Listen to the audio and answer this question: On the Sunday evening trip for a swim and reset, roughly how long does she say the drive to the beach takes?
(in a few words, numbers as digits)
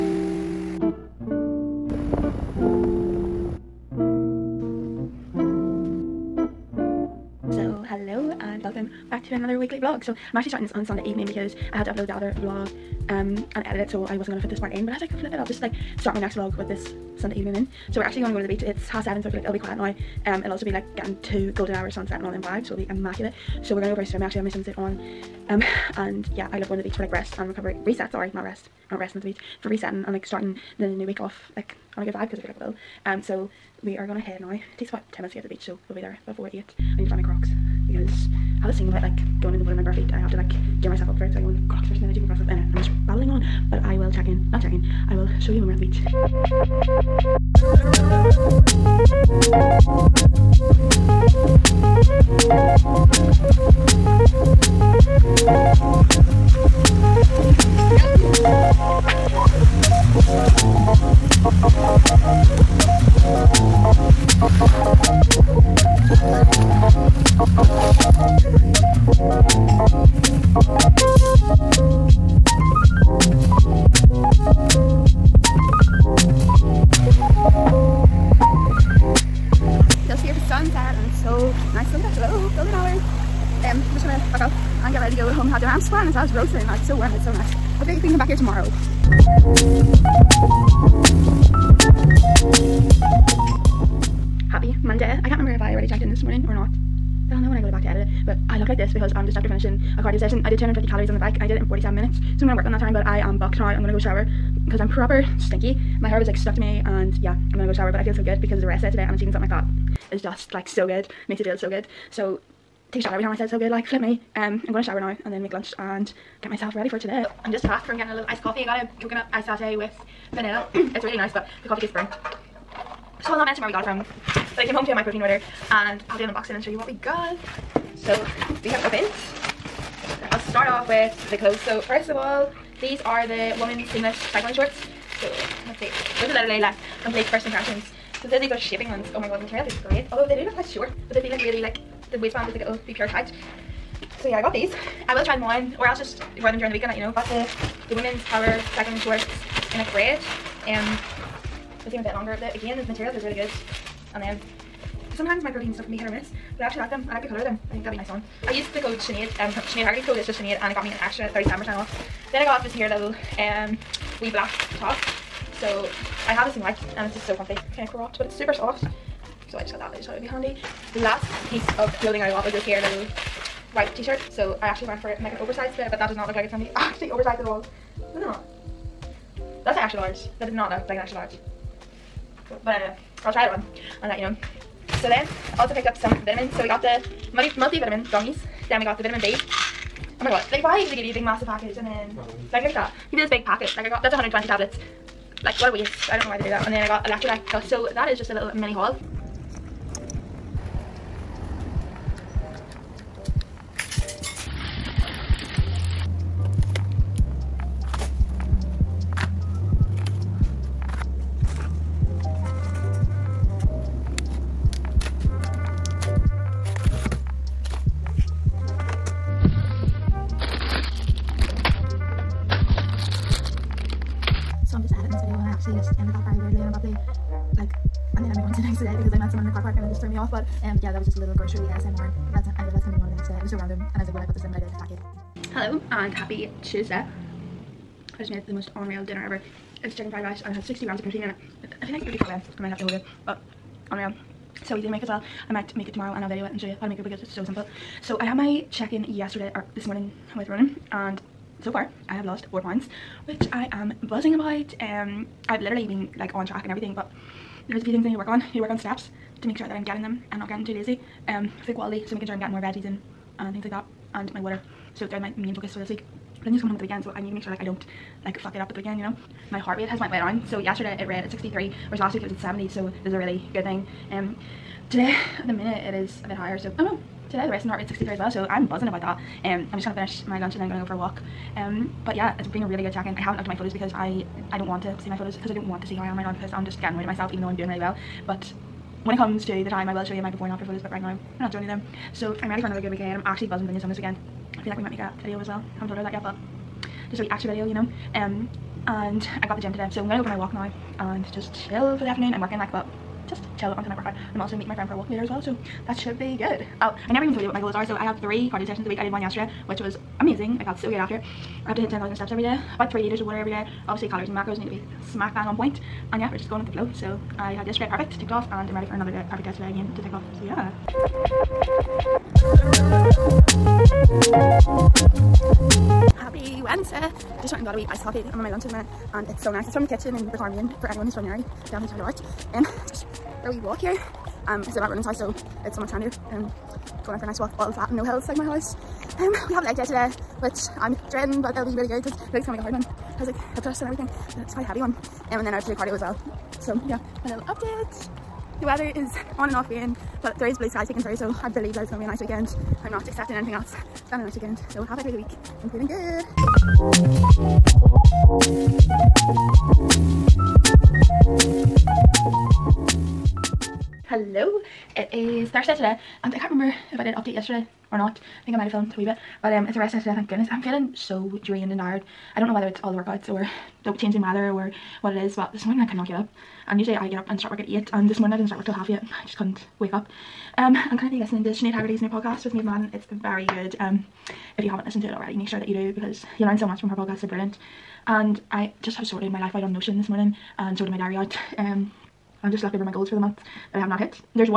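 10 minutes.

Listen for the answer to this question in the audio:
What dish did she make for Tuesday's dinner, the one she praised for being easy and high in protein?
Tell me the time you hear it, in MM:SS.
03:59.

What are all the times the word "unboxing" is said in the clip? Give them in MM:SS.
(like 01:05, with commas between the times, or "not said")
02:06.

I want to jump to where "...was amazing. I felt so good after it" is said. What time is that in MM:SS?
05:09.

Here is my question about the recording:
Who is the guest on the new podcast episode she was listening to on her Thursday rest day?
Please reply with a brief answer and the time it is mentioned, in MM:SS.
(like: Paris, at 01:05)
Maeve Madden, at 06:22.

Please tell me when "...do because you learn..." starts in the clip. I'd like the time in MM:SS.
06:25.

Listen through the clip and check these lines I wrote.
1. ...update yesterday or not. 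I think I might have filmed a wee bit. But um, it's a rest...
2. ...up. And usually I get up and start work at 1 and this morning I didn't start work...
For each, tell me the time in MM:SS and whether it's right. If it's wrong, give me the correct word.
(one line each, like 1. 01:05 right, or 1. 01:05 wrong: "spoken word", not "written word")
1. 06:07 right
2. 06:16 wrong: "8", not "1".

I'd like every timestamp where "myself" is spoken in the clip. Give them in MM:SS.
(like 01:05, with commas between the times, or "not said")
00:40, 01:56, 04:47.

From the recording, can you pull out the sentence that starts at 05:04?
I'm also meeting my friend for a walk later as well, so that should be good.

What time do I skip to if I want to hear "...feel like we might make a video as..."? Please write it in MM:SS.
04:54.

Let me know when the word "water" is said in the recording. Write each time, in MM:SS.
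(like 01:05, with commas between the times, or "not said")
00:39, 04:24, 05:13.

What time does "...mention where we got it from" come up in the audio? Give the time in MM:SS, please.
02:03.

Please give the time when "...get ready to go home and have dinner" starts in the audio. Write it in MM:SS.
01:24.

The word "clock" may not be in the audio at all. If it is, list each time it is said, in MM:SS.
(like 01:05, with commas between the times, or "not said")
not said.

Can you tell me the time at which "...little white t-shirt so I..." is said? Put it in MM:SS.
02:52.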